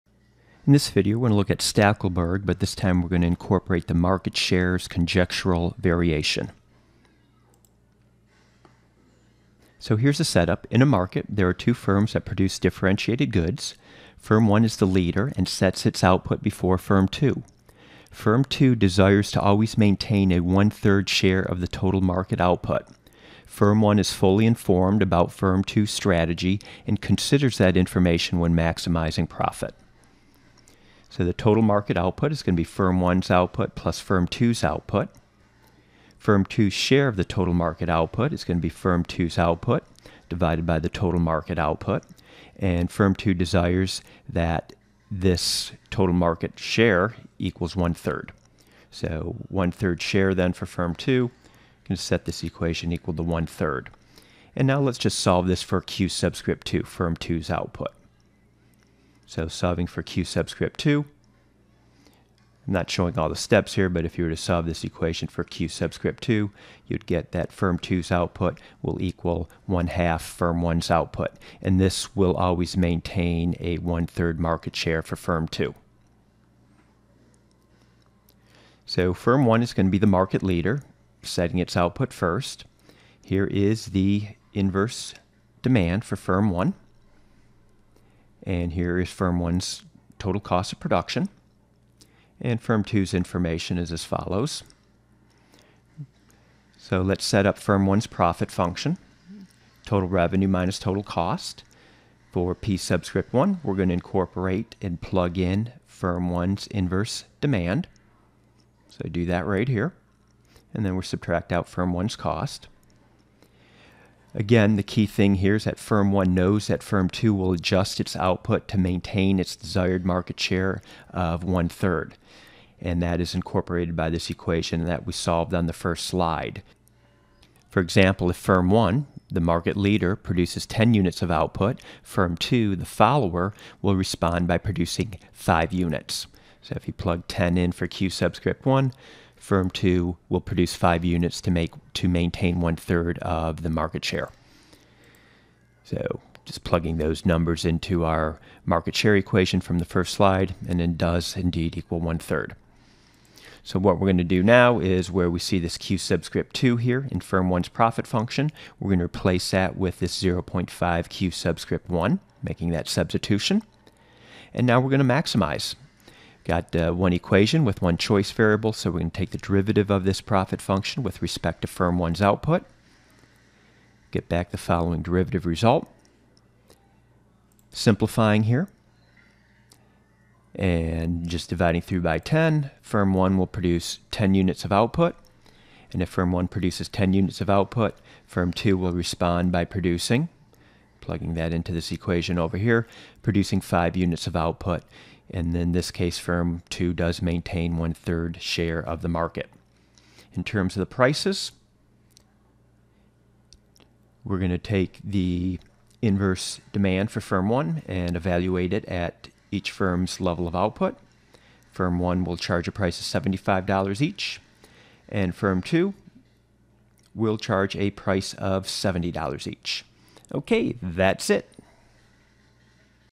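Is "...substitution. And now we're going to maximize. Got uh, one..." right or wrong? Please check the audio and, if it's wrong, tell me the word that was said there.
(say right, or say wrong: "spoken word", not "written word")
right.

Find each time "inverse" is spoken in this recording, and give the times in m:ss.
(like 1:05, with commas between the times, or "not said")
1:24, 1:46, 3:26.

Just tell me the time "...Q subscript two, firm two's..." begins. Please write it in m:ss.
0:55.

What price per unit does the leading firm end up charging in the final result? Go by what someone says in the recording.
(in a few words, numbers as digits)
$75.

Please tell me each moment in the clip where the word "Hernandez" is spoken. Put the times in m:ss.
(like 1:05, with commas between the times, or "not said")
not said.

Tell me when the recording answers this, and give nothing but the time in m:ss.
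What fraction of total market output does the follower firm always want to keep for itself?
0:20.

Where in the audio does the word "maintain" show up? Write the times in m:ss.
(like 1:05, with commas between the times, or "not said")
0:19, 1:12, 1:58, 2:22, 3:17.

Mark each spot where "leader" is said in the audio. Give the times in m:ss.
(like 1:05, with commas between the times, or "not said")
0:14, 1:20, 2:09.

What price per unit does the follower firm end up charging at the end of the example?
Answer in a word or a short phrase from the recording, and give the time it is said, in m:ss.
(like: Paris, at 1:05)
$70, at 3:38.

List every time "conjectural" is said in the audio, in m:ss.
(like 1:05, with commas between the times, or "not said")
0:04.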